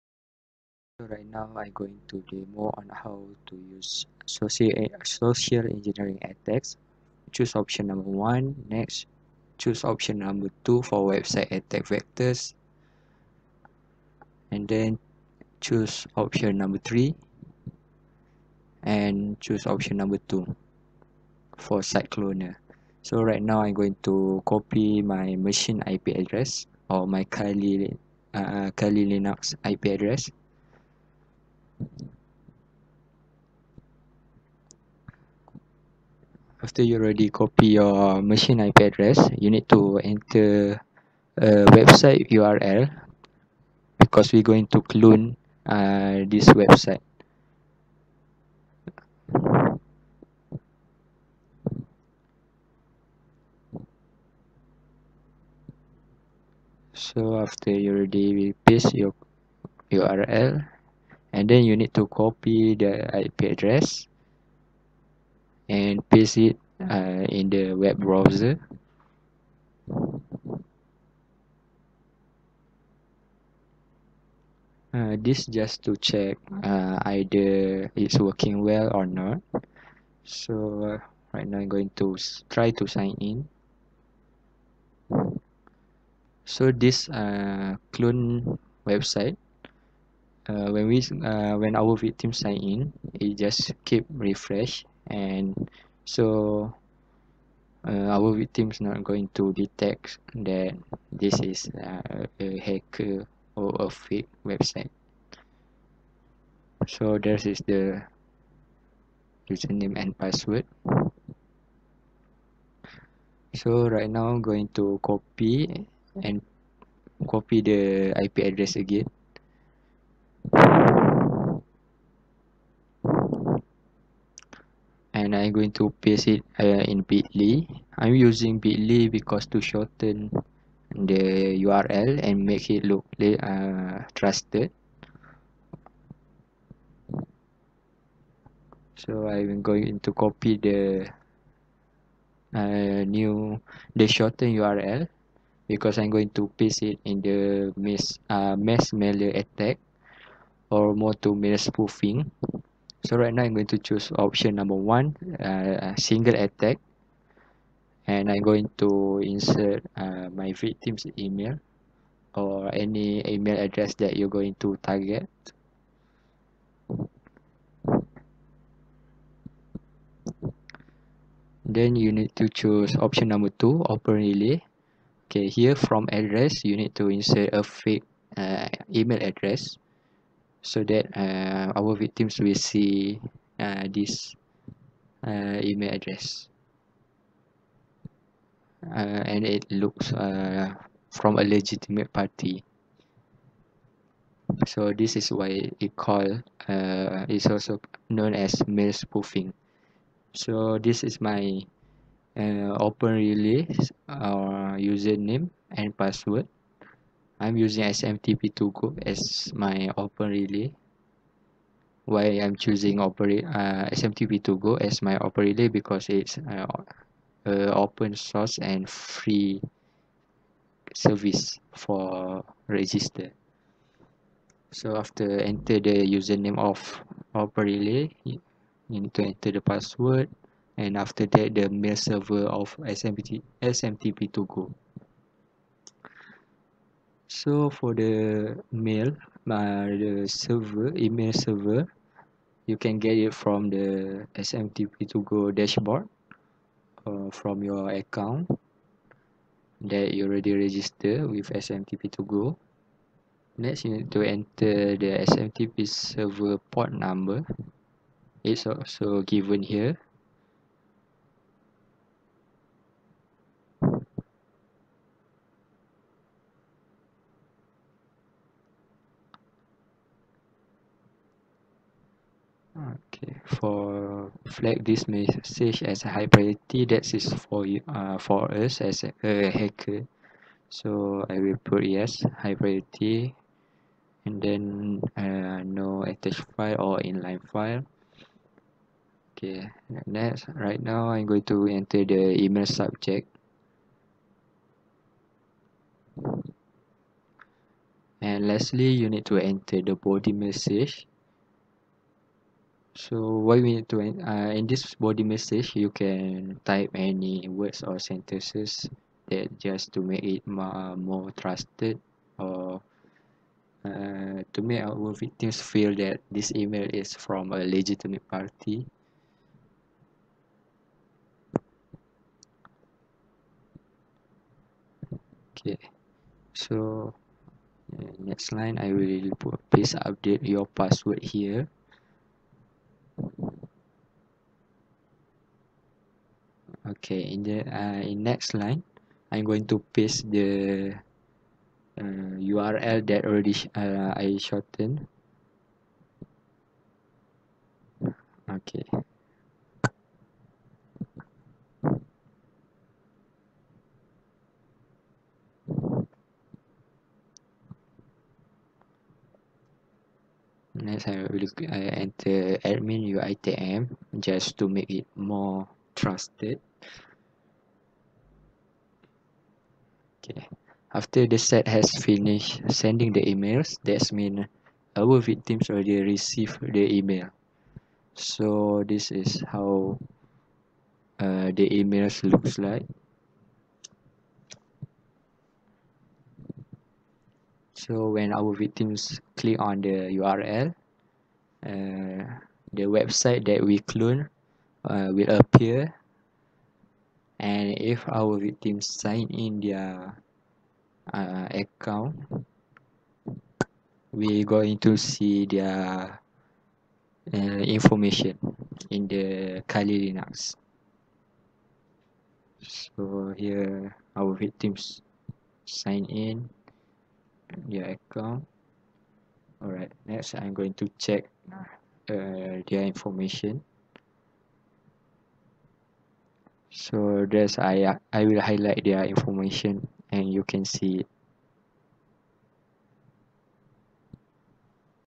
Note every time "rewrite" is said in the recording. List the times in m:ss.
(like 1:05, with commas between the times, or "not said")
not said.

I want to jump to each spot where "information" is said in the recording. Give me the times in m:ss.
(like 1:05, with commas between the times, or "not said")
6:47, 7:02, 7:09.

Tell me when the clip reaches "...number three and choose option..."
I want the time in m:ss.
0:16.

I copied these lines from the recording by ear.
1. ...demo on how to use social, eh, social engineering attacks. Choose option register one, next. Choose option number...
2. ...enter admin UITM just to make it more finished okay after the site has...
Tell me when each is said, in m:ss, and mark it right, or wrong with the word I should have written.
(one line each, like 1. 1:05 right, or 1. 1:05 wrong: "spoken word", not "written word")
1. 0:02 wrong: "number", not "register"
2. 6:02 wrong: "trusted", not "finished".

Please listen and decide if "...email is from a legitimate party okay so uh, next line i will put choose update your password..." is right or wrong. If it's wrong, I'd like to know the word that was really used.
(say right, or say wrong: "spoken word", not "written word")
wrong: "please", not "choose".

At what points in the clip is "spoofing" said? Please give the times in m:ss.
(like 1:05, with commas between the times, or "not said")
2:31, 3:18.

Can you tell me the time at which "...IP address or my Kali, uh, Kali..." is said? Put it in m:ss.
0:25.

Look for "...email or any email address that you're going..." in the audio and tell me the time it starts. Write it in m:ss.
2:41.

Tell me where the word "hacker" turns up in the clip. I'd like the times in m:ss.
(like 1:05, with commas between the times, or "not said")
1:42, 4:39.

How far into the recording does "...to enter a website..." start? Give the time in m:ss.
0:39.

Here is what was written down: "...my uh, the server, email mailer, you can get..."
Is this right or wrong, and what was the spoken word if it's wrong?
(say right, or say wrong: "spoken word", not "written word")
wrong: "server", not "mailer".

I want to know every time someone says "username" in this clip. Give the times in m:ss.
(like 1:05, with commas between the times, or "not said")
1:49, 3:24, 3:46.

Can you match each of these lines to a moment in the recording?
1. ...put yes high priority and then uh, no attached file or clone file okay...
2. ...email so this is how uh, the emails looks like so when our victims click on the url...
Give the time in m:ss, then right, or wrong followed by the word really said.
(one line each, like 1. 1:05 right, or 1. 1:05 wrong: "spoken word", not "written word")
1. 4:41 wrong: "inline", not "clone"
2. 6:16 right.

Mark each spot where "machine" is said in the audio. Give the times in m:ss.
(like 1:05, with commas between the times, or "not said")
0:25, 0:38.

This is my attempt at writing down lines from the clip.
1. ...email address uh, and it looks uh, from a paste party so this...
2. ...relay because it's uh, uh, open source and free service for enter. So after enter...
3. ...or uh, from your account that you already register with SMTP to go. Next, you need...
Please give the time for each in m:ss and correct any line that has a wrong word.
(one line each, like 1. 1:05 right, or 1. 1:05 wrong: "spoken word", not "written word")
1. 3:05 wrong: "legitimate", not "paste"
2. 3:35 wrong: "register", not "enter"
3. 4:07 right.